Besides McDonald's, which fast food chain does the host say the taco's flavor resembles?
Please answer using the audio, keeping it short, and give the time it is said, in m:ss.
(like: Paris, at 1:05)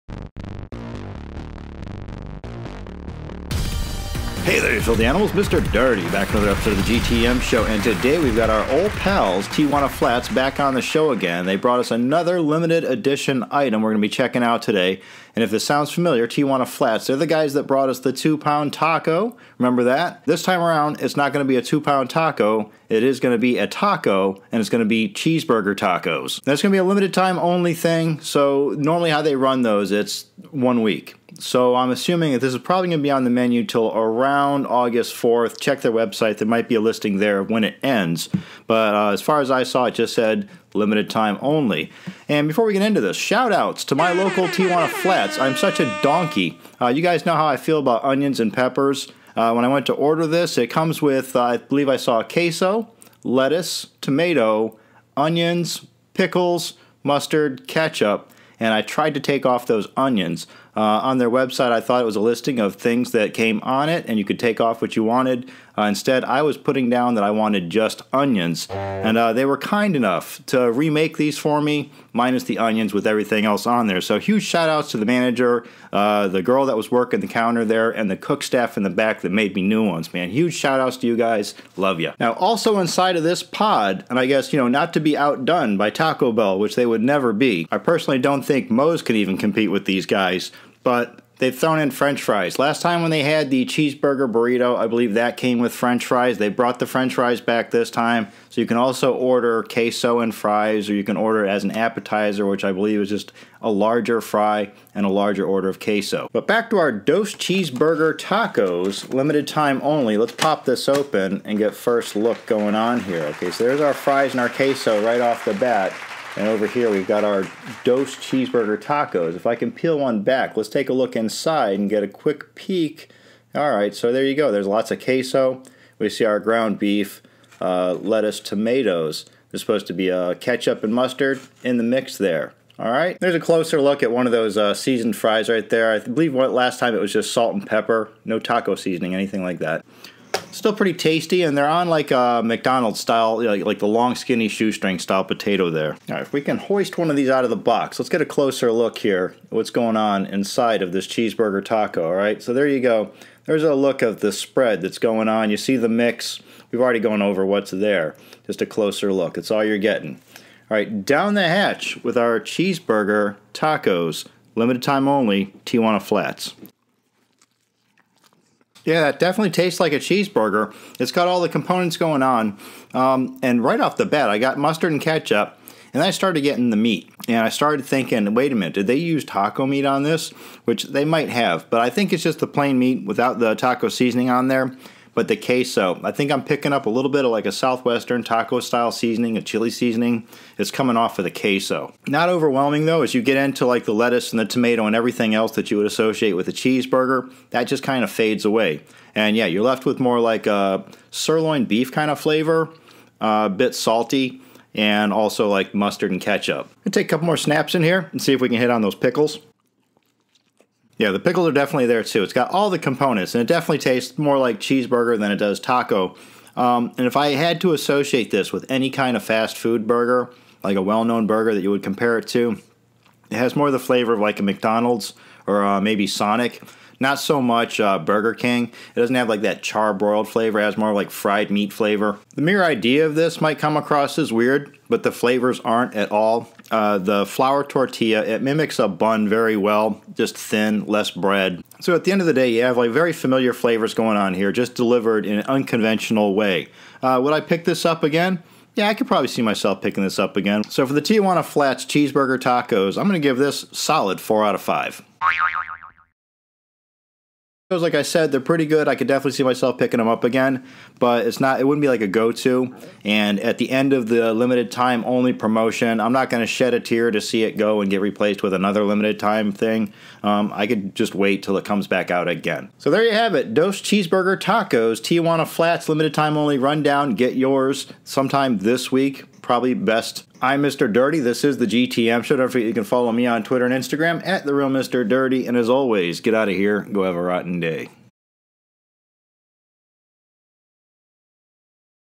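Sonic, at 3:46.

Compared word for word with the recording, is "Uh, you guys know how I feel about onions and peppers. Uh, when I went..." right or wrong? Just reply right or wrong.
right.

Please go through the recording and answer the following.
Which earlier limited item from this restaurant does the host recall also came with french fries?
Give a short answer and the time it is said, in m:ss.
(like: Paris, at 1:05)
cheeseburger burrito, at 1:33.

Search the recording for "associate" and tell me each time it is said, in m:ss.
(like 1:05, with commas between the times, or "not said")
3:15, 3:37.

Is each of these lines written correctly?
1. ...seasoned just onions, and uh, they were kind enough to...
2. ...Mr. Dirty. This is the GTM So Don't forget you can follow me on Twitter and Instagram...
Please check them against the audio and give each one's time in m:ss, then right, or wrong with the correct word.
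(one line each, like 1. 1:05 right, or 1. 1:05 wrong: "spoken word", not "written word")
1. 1:07 wrong: "wanted", not "seasoned"
2. 4:40 right.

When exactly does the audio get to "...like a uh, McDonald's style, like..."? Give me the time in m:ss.
2:21.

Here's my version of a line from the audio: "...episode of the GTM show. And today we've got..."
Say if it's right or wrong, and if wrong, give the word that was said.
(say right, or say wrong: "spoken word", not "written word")
right.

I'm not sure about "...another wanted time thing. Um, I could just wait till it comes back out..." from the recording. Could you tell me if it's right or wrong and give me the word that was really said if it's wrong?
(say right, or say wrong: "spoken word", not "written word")
wrong: "limited", not "wanted".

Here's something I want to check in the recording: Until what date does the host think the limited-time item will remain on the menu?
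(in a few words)
August 4th.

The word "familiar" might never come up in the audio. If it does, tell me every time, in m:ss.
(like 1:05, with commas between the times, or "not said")
0:15, 4:03.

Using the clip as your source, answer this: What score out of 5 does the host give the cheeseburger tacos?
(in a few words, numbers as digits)
4.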